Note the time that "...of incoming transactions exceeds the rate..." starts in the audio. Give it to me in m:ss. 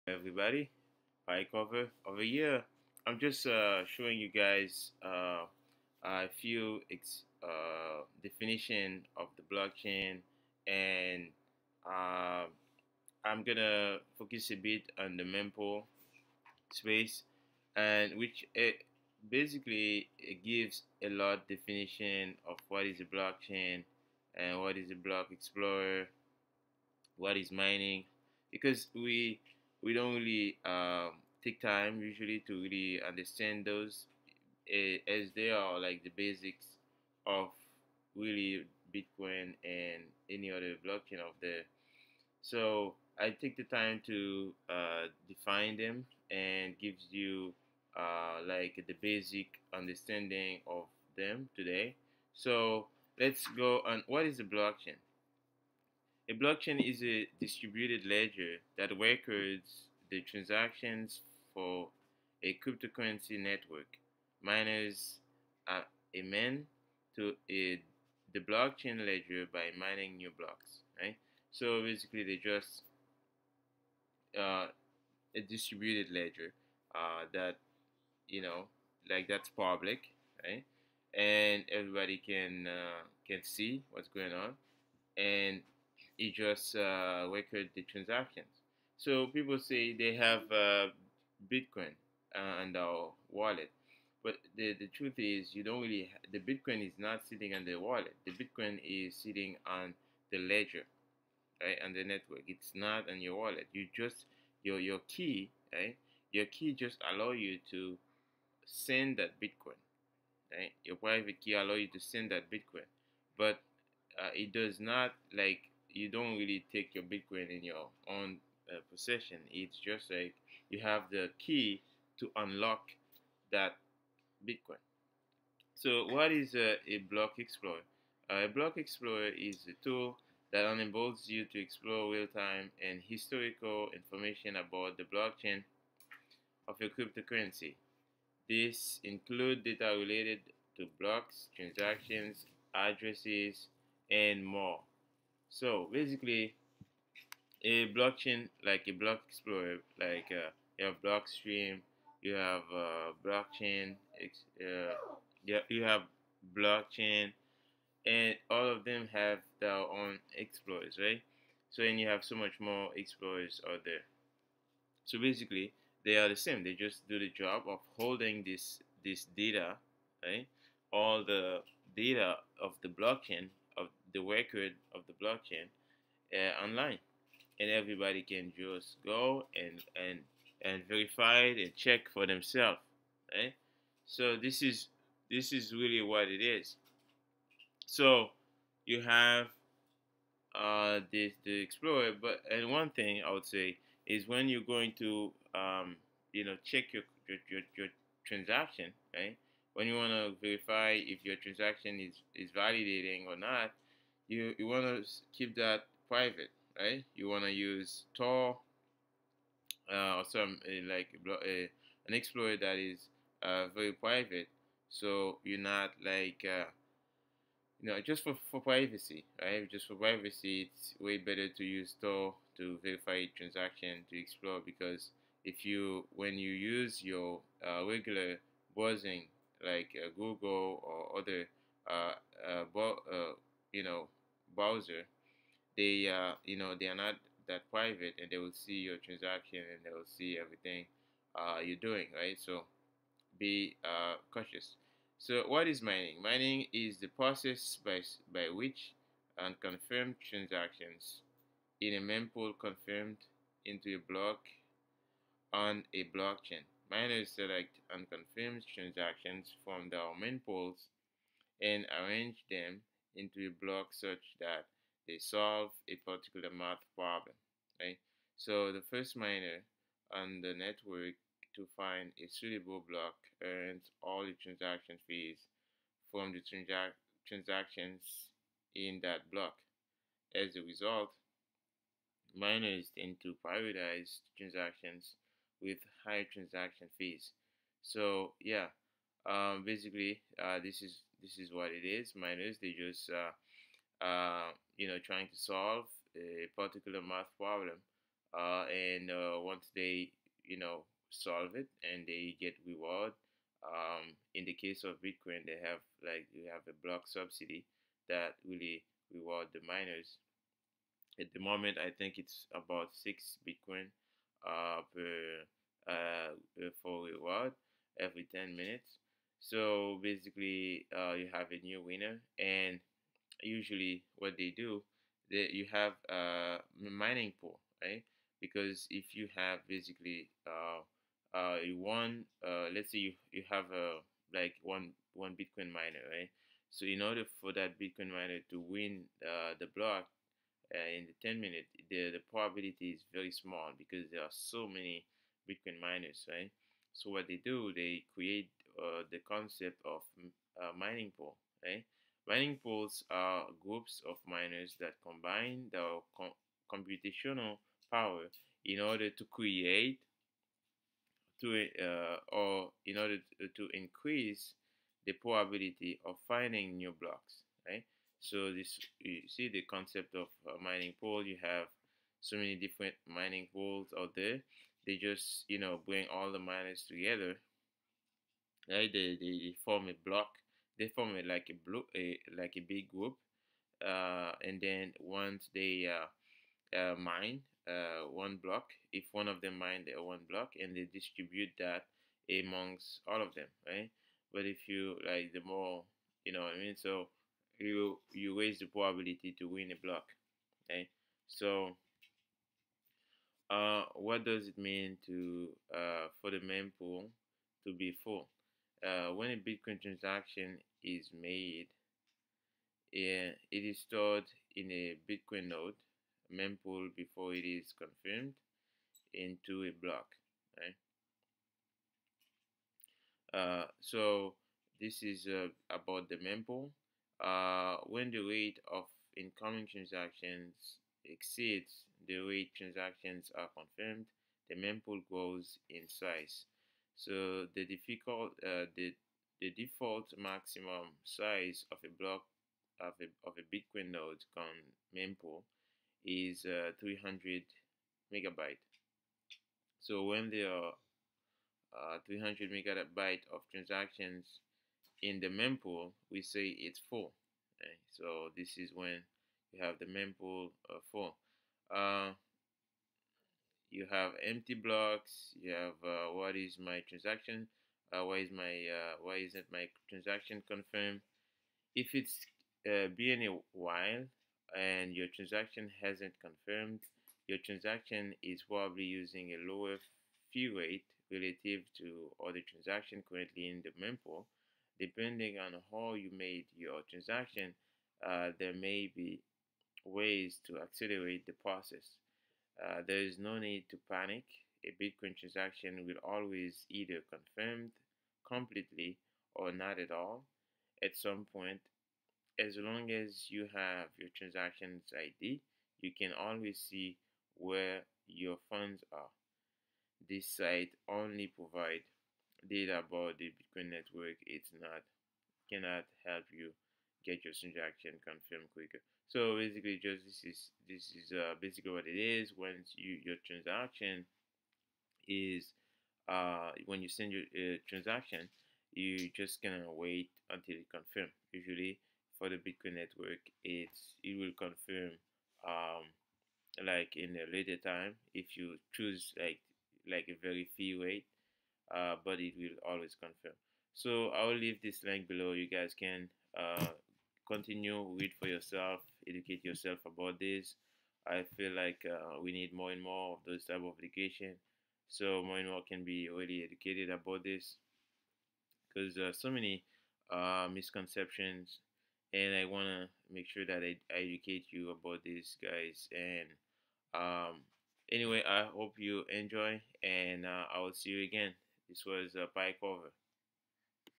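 7:08.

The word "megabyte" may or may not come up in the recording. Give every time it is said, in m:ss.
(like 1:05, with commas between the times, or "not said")
7:28, 7:32.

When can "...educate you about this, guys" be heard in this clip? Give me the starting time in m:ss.
9:24.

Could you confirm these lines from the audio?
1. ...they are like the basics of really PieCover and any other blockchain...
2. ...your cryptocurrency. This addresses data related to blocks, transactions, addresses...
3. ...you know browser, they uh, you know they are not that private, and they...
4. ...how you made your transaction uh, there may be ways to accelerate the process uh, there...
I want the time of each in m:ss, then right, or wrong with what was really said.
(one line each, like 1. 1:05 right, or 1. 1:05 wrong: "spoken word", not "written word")
1. 0:35 wrong: "Bitcoin", not "PieCover"
2. 2:16 wrong: "includes", not "addresses"
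3. 3:53 right
4. 8:05 right.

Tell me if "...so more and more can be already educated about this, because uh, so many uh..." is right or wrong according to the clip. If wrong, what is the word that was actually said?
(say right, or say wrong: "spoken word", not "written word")
right.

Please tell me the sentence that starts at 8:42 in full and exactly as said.
When you your transaction is uh, when you send your uh, transaction, you just gonna wait until it confirm.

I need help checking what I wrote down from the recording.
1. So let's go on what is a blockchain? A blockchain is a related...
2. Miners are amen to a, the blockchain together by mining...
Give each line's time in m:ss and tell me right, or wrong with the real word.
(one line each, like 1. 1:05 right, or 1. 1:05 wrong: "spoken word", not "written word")
1. 0:52 wrong: "distributed", not "related"
2. 1:04 wrong: "ledger", not "together".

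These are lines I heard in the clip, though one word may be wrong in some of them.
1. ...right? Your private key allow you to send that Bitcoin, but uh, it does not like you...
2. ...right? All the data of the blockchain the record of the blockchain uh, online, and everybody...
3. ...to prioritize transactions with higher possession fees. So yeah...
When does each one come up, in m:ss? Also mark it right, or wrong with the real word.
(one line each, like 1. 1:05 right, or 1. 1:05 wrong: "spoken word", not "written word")
1. 1:50 right
2. 2:50 right
3. 4:43 wrong: "transaction", not "possession".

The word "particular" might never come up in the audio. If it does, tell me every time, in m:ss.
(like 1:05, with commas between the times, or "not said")
4:26, 4:56.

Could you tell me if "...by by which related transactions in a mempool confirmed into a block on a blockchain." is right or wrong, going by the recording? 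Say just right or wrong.
wrong.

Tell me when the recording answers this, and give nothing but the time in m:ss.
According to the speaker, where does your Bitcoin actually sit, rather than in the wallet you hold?
1:38.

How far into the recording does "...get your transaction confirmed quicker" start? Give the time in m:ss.
8:37.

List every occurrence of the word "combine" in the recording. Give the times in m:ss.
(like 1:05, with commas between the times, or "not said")
5:55.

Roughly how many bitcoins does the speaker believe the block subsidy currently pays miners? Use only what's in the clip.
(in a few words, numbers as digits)
About 6.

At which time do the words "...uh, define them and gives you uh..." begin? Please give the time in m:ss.
0:44.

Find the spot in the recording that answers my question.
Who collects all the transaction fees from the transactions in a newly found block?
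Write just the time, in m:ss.
4:28.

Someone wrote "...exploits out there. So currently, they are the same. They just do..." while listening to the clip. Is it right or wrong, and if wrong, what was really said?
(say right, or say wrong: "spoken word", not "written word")
wrong: "basically", not "currently".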